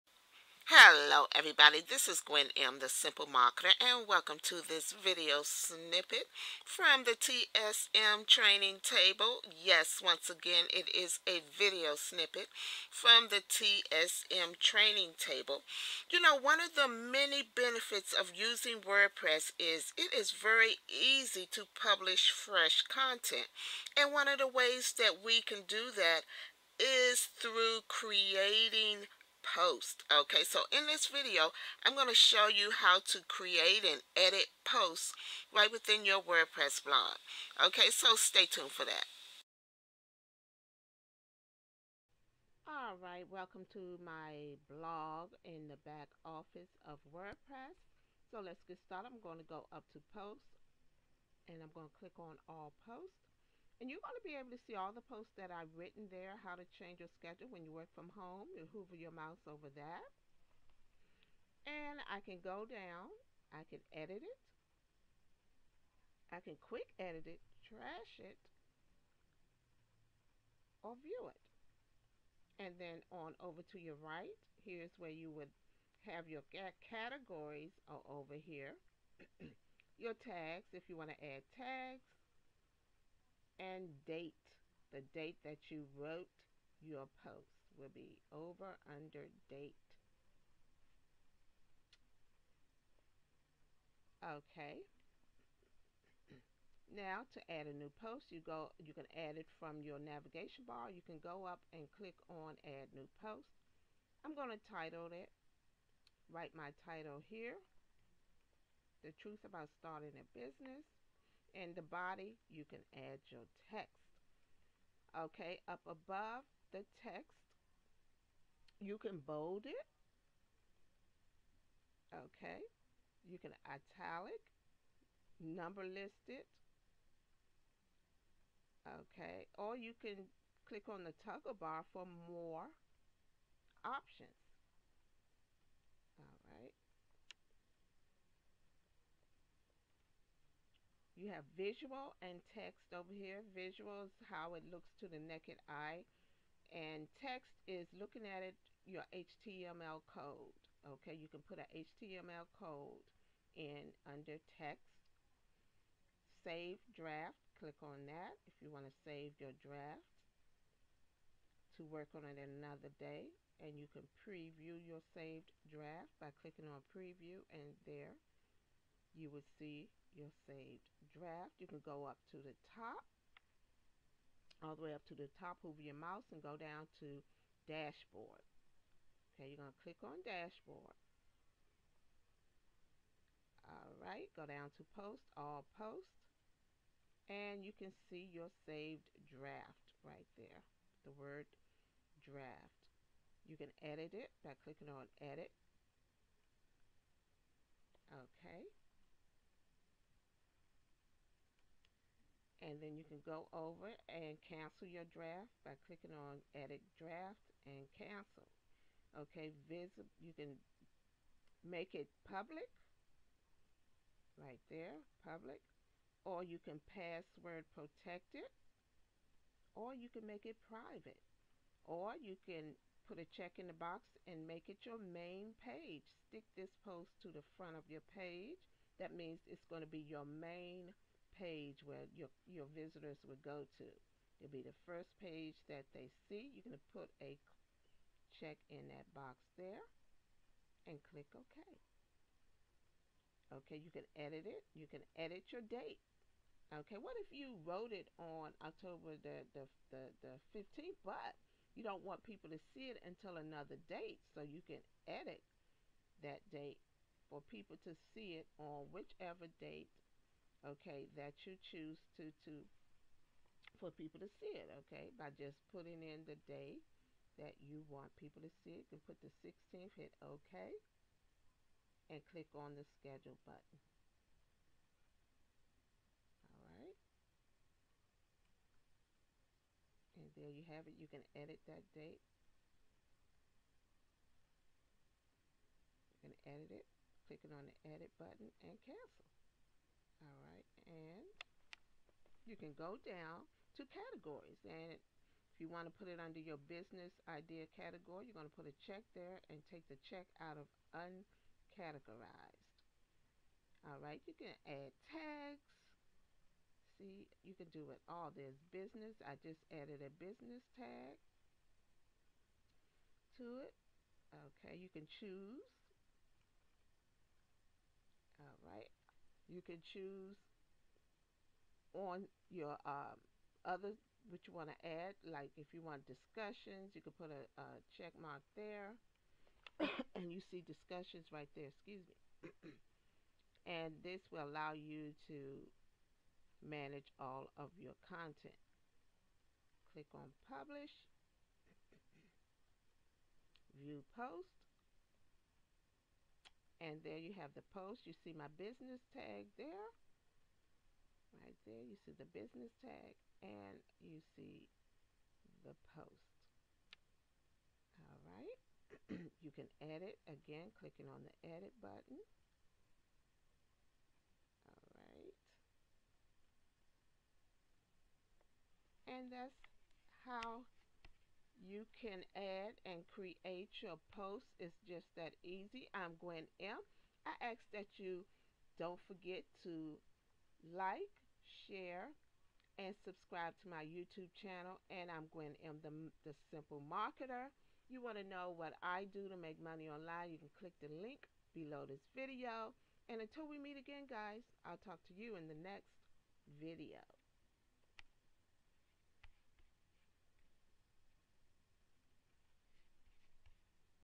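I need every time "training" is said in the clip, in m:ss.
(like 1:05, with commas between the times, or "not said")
0:08, 0:14.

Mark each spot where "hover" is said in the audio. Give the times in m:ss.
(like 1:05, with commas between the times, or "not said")
0:58, 2:55.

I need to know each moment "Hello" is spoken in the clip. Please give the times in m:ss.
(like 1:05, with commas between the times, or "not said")
0:00.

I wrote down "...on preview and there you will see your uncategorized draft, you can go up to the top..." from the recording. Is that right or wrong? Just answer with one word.
wrong.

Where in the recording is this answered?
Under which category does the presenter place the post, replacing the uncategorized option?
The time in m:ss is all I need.
4:56.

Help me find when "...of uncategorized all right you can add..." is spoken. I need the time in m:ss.
5:00.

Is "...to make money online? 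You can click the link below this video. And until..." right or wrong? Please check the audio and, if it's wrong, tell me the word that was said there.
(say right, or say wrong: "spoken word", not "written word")
right.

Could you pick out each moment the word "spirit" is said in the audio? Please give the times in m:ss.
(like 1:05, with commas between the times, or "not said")
not said.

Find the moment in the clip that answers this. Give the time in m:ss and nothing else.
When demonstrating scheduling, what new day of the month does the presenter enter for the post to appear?
4:29.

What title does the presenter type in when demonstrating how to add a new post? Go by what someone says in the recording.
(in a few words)
The truth about starting a business.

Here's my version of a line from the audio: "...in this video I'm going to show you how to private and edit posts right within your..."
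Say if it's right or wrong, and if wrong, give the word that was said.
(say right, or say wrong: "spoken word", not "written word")
wrong: "create", not "private".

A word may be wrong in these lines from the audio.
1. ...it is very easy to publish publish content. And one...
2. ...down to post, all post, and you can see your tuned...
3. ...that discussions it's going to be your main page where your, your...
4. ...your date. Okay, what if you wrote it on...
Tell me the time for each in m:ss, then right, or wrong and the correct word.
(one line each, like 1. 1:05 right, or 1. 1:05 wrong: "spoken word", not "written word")
1. 0:19 wrong: "fresh", not "publish"
2. 3:04 wrong: "saved", not "tuned"
3. 3:48 wrong: "means", not "discussions"
4. 4:05 right.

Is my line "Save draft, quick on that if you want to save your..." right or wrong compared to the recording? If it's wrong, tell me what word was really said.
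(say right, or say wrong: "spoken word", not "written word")
wrong: "click", not "quick".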